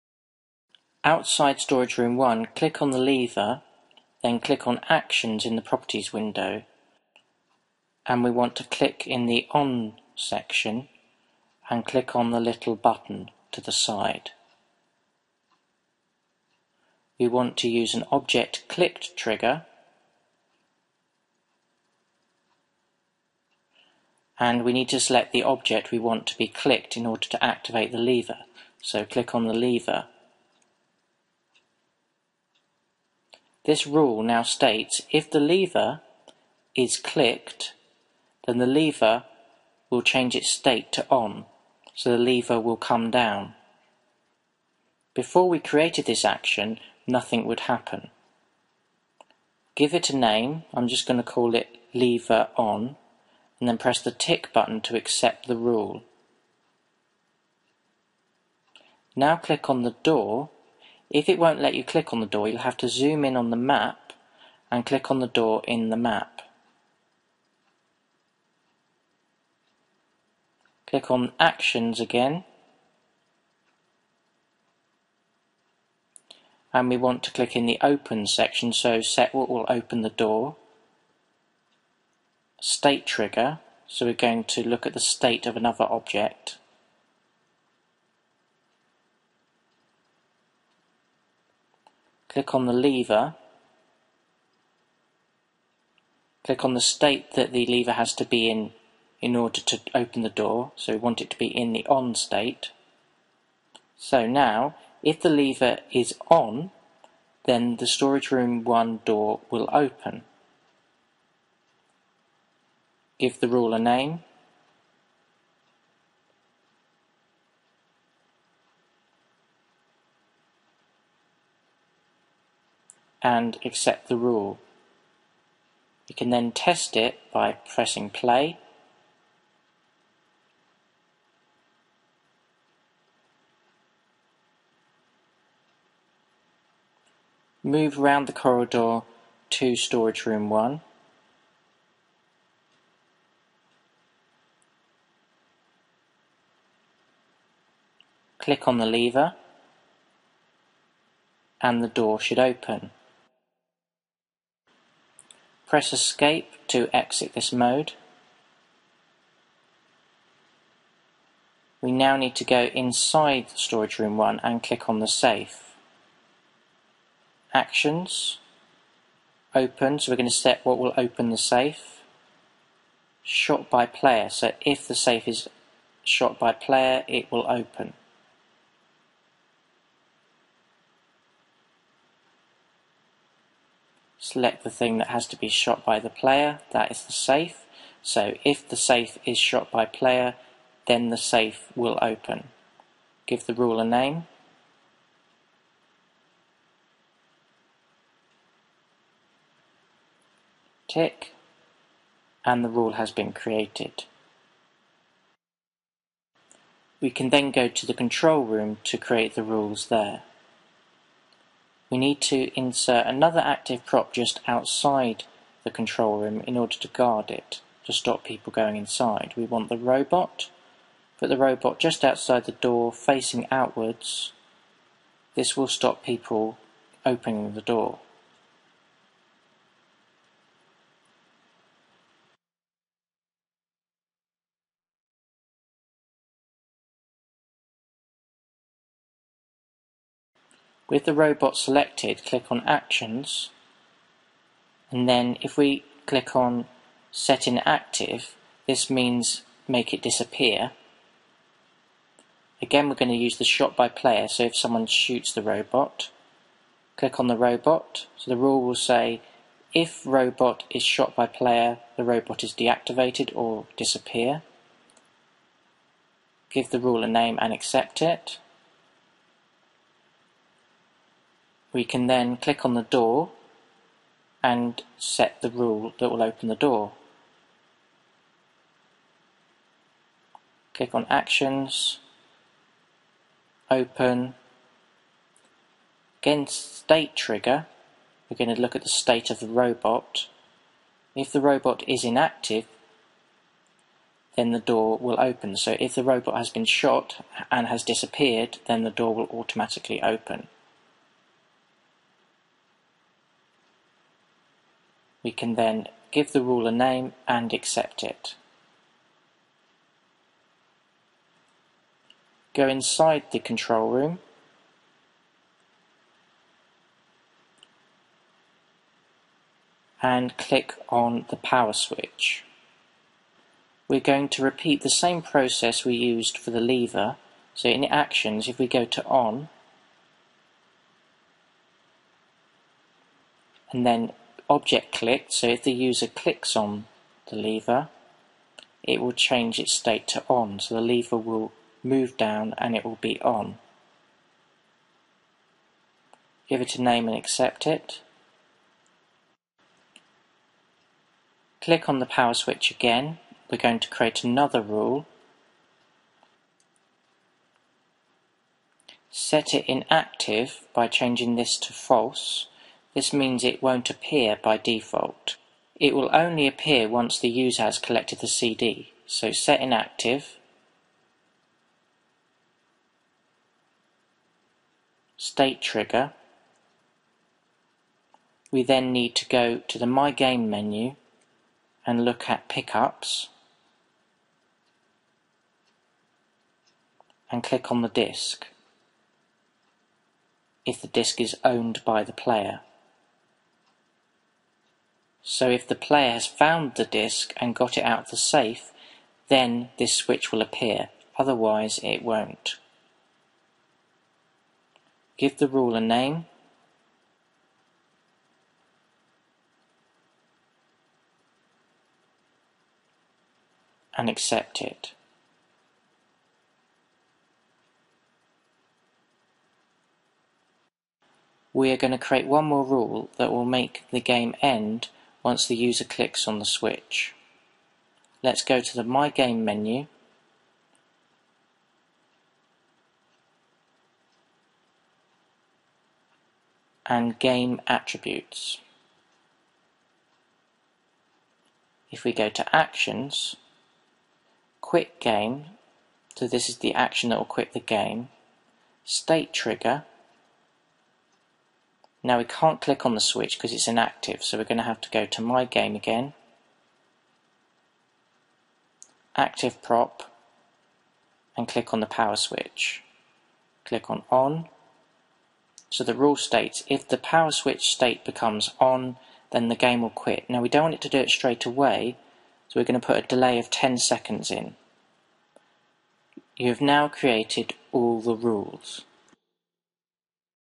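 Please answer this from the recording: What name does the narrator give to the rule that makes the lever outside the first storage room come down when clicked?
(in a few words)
lever on.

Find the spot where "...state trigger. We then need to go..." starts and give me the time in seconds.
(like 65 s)
375 s.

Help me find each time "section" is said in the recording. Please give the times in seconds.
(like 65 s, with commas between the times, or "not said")
10 s, 78 s.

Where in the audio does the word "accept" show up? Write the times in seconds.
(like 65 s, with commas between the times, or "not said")
54 s, 123 s, 267 s, 307 s, 347 s, 414 s.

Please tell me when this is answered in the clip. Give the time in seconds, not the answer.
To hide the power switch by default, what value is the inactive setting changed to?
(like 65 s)
361 s.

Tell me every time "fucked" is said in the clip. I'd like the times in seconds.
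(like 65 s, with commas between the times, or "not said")
not said.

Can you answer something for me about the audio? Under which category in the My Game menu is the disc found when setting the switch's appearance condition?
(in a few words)
pickups.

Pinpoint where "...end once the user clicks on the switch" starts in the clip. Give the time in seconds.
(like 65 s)
424 s.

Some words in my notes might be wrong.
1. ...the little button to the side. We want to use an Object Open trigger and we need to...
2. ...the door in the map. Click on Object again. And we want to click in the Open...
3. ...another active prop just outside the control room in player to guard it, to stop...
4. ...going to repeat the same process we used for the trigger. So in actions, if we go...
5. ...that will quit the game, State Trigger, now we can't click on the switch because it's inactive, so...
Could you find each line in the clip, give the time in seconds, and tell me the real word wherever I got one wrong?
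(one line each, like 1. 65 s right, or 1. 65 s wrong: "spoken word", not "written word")
1. 12 s wrong: "Clicked", not "Open"
2. 65 s wrong: "Actions", not "Object"
3. 213 s wrong: "order", not "player"
4. 323 s wrong: "lever", not "trigger"
5. 447 s right.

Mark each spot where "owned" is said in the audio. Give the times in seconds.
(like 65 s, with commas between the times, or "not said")
391 s.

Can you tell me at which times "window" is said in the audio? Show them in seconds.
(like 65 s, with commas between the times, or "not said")
6 s.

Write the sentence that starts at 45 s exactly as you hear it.
Before we created this action, nothing would happen.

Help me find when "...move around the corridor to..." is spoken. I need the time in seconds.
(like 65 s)
137 s.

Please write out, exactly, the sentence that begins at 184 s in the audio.
select the thing that has to be shot by the player, that is the safe.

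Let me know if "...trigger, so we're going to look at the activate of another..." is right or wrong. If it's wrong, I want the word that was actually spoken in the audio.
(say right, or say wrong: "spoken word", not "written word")
wrong: "state", not "activate".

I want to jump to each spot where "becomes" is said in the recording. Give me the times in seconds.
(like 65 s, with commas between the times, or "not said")
468 s.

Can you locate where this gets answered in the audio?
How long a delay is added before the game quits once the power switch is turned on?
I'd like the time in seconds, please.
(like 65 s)
473 s.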